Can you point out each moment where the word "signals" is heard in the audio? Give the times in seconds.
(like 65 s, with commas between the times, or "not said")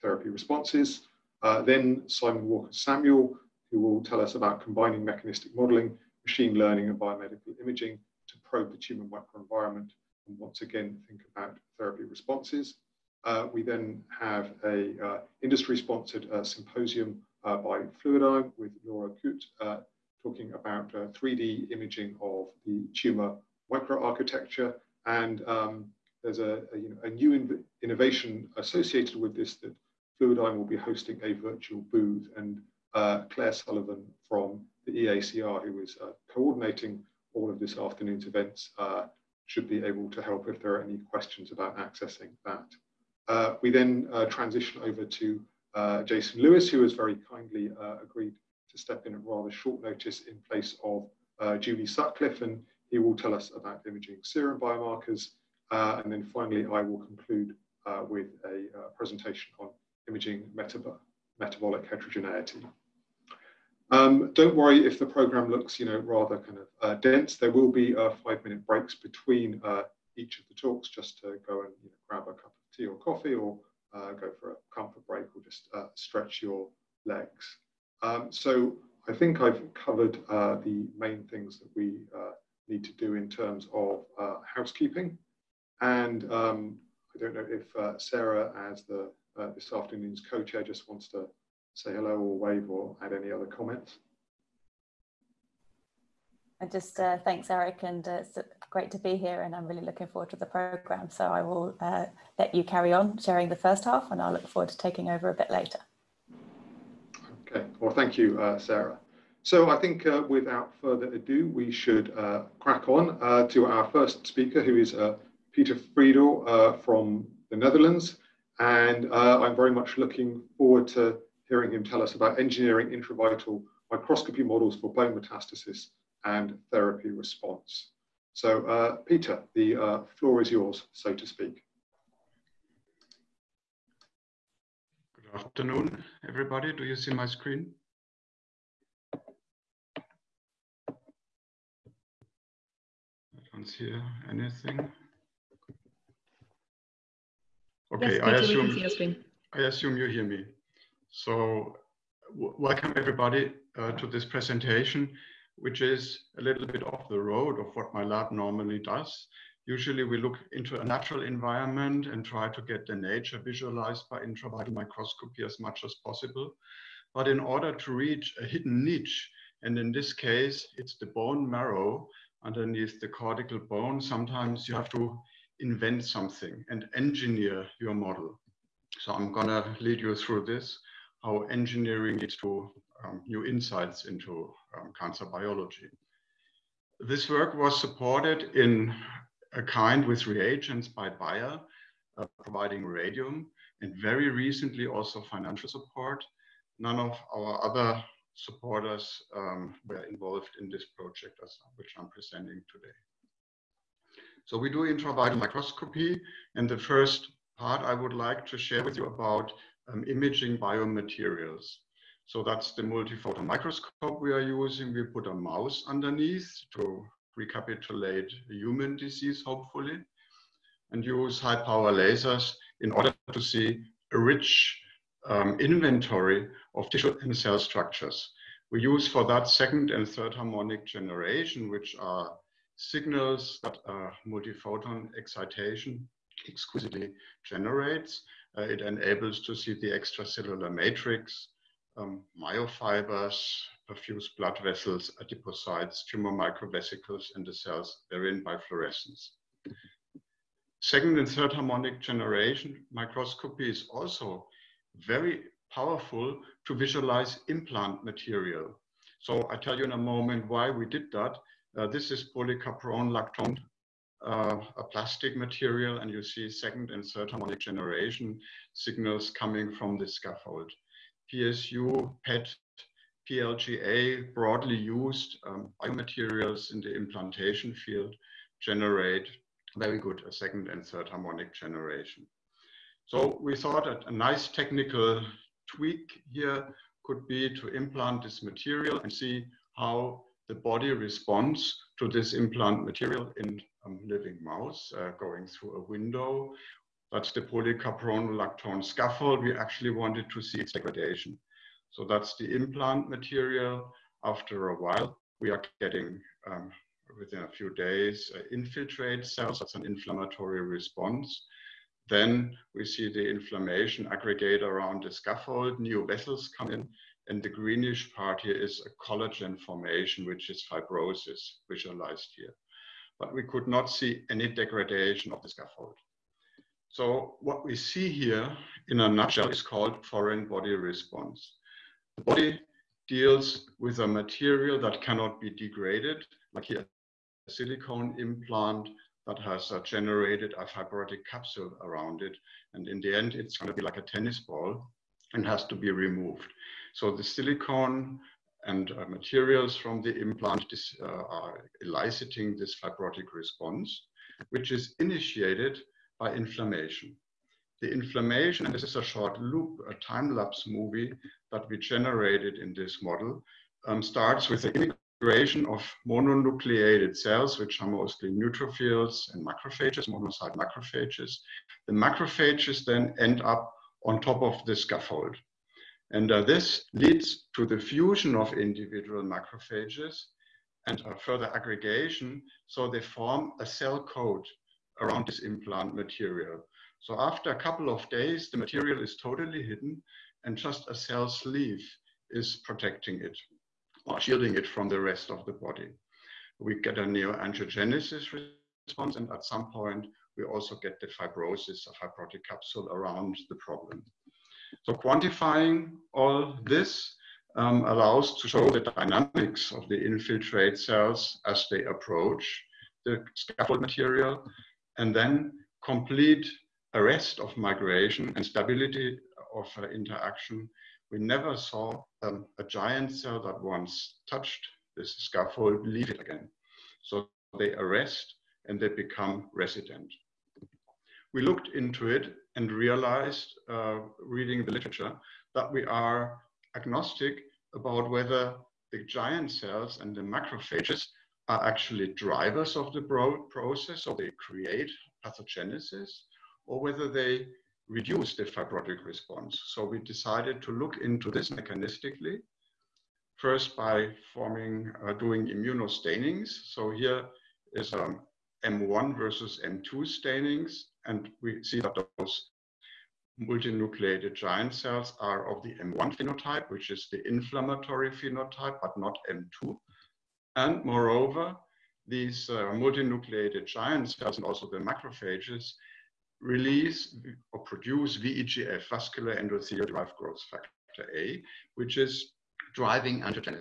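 232 s, 268 s.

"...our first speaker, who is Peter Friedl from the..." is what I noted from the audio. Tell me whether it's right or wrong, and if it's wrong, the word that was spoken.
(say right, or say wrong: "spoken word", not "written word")
right.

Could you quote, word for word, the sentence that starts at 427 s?
So they arrest and they become resident.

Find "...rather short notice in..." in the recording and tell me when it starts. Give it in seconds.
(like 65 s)
49 s.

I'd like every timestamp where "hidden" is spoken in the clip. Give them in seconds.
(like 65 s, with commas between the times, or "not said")
168 s, 389 s.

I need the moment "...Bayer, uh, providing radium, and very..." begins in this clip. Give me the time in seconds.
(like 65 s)
191 s.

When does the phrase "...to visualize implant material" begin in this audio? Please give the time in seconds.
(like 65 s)
256 s.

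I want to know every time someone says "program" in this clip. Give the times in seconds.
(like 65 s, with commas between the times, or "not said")
65 s, 100 s.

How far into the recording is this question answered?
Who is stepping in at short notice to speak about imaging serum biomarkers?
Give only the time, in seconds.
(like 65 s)
46 s.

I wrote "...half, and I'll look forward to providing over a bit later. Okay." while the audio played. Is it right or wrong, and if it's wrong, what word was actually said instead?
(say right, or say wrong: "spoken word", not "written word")
wrong: "taking", not "providing".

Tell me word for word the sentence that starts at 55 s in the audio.
Uh, and then finally, I will conclude uh, with a uh, presentation on imaging metab metabolic heterogeneity.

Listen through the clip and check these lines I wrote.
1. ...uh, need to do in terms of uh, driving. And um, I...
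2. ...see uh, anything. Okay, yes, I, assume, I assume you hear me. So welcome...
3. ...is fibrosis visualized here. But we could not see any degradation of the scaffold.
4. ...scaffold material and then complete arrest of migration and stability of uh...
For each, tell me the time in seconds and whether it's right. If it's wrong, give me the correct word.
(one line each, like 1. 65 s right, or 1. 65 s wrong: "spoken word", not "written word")
1. 82 s wrong: "housekeeping", not "driving"
2. 143 s right
3. 320 s right
4. 413 s right.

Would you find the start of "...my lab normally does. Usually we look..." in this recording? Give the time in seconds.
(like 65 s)
157 s.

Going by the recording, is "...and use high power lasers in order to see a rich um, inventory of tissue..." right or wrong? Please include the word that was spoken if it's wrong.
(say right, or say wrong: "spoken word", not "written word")
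right.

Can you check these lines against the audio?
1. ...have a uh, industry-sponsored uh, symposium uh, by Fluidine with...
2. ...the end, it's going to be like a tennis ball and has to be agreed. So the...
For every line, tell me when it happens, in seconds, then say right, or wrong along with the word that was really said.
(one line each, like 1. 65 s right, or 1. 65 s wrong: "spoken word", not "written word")
1. 14 s right
2. 343 s wrong: "removed", not "agreed".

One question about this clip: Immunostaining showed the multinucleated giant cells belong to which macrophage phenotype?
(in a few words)
M1.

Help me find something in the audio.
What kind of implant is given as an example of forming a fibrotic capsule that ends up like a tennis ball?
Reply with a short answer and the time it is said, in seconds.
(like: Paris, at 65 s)
silicone implant, at 337 s.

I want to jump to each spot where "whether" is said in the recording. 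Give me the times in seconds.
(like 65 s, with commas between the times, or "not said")
438 s, 446 s.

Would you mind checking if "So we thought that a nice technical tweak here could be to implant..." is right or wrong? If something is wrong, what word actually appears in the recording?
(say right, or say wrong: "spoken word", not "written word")
right.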